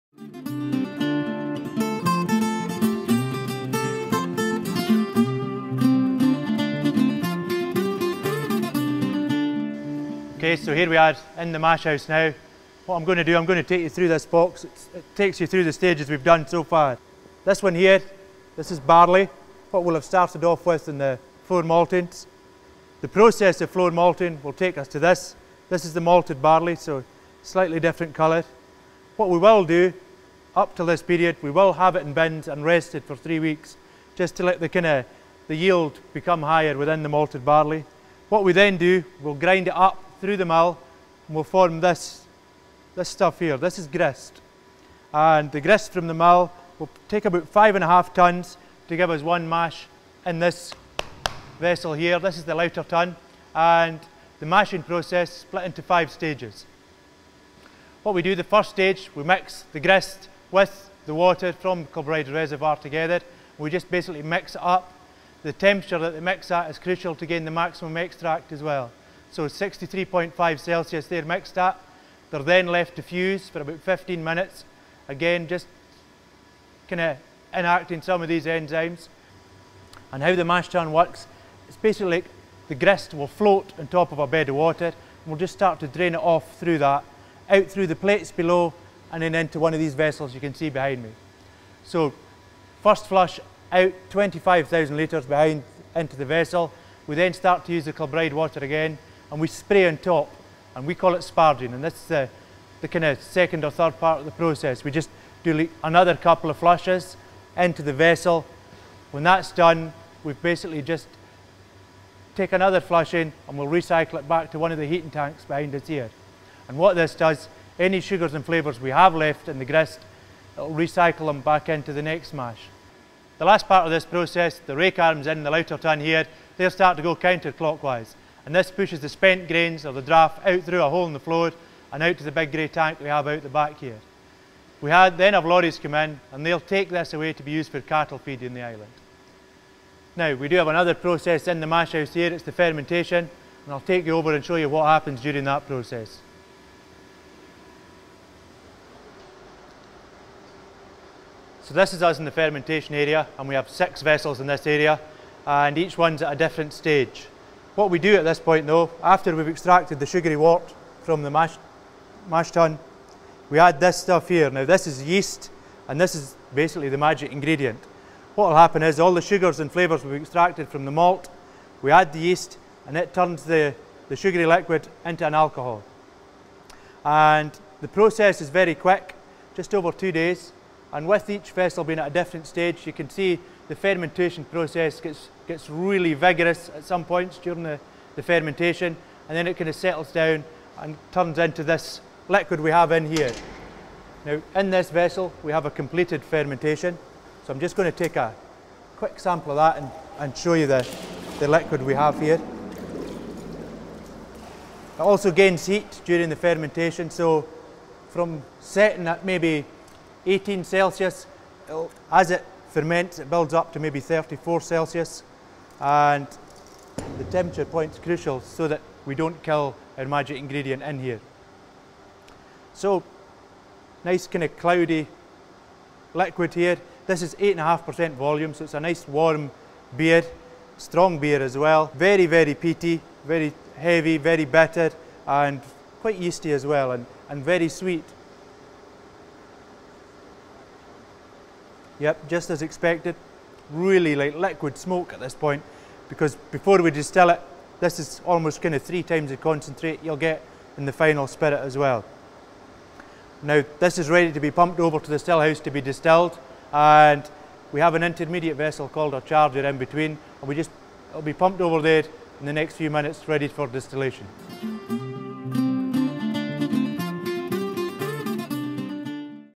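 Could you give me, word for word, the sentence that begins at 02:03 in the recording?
The last part of this process, the rake arms in the lauter tun here, they'll start to go counterclockwise.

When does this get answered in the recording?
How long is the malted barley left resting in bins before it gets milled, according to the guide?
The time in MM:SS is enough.
00:33.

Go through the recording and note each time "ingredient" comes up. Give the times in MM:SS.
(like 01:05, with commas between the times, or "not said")
02:47, 03:40.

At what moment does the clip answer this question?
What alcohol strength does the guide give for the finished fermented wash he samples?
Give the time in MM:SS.
03:47.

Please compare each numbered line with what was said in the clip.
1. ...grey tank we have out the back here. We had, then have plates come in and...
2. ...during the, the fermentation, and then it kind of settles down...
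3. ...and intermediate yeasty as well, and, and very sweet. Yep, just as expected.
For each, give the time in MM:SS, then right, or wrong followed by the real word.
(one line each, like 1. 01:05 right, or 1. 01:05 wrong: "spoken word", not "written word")
1. 02:12 wrong: "lorries", not "plates"
2. 03:07 right
3. 03:55 wrong: "quite", not "intermediate".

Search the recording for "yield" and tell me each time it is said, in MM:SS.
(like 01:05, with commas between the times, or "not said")
00:35.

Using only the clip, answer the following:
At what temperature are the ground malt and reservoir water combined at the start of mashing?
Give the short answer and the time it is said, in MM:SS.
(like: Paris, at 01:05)
63.5 Celsius, at 01:09.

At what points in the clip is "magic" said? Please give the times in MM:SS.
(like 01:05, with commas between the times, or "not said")
02:46, 03:40.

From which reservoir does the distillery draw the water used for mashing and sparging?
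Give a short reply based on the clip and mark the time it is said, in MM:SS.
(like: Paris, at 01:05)
Kilbride Reservoir, at 01:01.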